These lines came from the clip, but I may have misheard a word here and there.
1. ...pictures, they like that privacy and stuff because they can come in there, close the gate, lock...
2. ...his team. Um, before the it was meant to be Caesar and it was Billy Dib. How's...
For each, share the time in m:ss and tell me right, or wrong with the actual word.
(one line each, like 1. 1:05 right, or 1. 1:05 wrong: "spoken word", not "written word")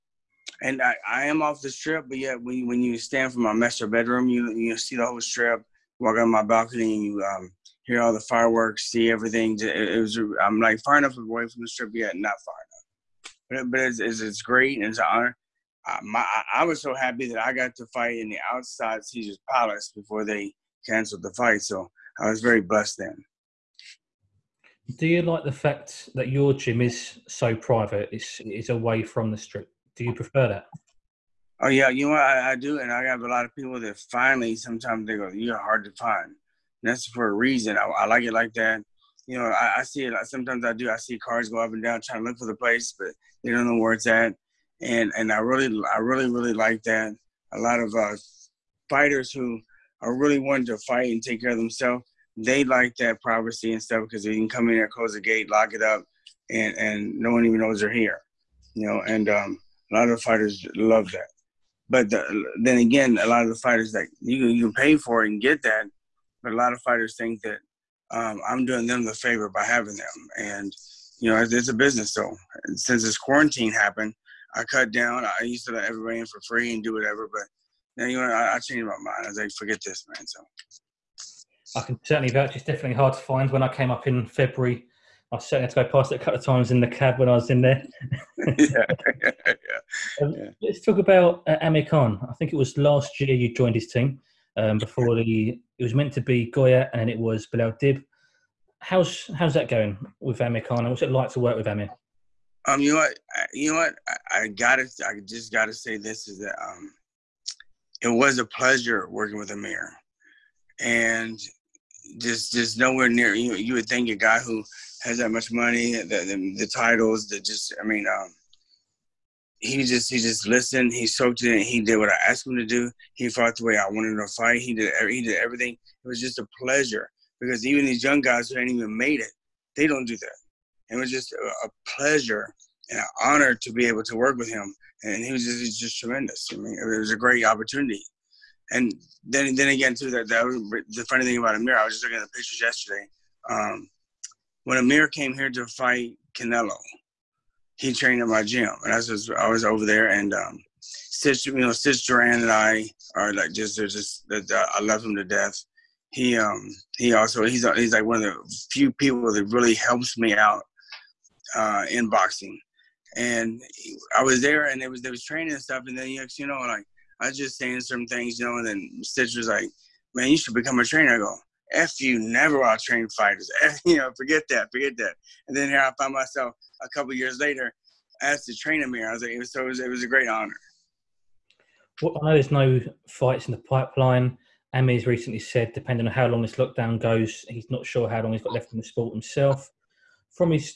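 1. 0:51 wrong: "themselves", not "pictures"
2. 1:33 wrong: "Goyat", not "Caesar".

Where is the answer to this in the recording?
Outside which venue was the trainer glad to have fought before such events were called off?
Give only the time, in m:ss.
0:19.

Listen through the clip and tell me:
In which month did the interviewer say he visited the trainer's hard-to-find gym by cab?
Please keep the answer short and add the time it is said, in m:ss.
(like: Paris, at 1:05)
February, at 1:24.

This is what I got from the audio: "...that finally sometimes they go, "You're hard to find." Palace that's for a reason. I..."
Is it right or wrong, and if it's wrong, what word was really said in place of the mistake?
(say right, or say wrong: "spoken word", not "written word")
wrong: "And", not "Palace".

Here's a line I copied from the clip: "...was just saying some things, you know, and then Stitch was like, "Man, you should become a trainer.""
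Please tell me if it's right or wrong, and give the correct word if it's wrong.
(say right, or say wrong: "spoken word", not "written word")
right.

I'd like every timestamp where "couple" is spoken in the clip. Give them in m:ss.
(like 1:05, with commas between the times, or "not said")
1:26, 2:56.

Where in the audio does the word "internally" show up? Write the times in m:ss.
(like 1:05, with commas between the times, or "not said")
not said.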